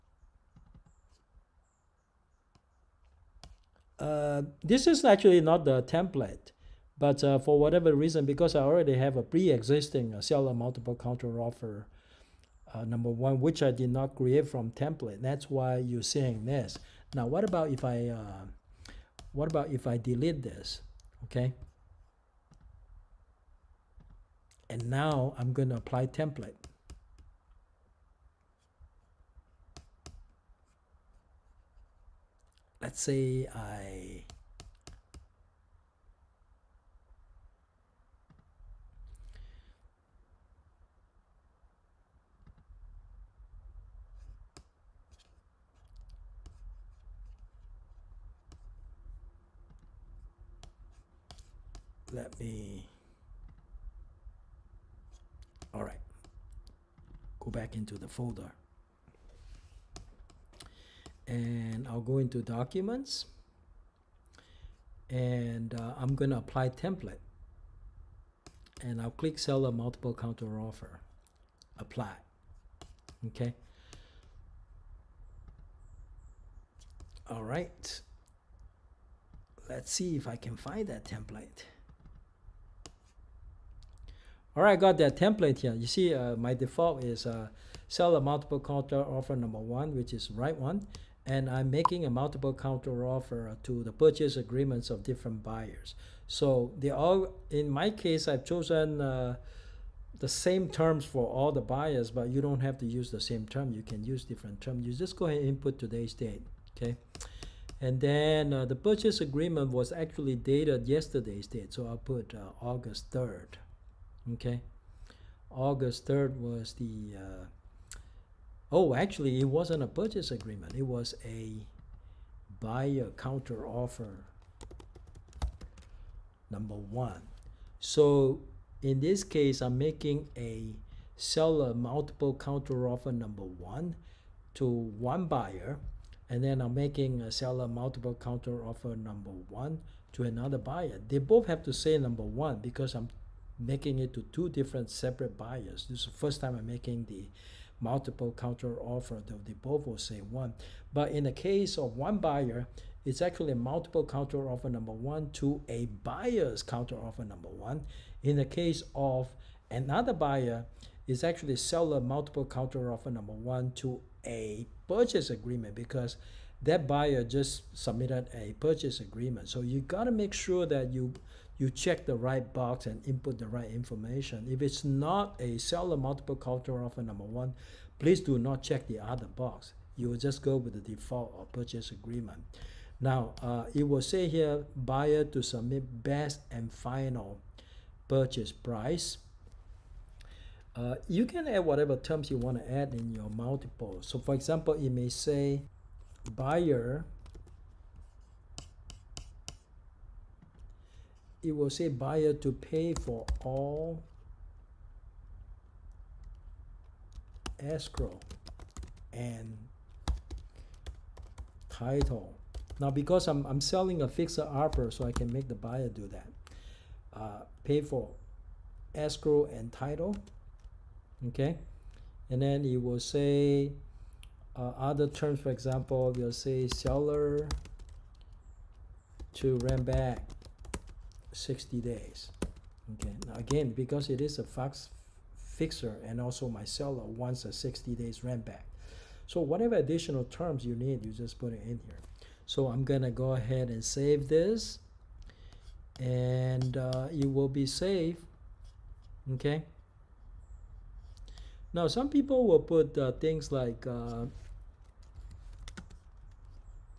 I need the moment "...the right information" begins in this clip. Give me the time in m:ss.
2:53.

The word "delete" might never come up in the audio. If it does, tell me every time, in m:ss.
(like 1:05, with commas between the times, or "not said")
0:19.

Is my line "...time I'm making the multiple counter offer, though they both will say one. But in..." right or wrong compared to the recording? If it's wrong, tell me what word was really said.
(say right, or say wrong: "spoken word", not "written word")
right.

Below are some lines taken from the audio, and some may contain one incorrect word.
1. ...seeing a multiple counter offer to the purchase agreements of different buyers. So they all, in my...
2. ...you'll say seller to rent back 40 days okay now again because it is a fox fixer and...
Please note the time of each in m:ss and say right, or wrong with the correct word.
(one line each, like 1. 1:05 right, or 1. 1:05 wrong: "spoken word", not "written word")
1. 1:31 wrong: "making", not "seeing"
2. 3:46 wrong: "60", not "40".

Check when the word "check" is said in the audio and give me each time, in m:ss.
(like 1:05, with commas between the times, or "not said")
2:51, 2:58.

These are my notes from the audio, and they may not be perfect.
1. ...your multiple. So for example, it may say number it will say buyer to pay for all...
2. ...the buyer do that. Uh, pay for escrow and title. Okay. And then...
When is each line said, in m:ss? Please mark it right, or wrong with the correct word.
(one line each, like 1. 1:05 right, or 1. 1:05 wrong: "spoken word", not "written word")
1. 3:13 wrong: "buyer", not "number"
2. 3:35 right.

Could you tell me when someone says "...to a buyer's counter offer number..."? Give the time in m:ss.
2:35.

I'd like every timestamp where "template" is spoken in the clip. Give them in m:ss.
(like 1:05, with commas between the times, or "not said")
0:05, 0:14, 0:26, 1:06, 1:21, 1:25.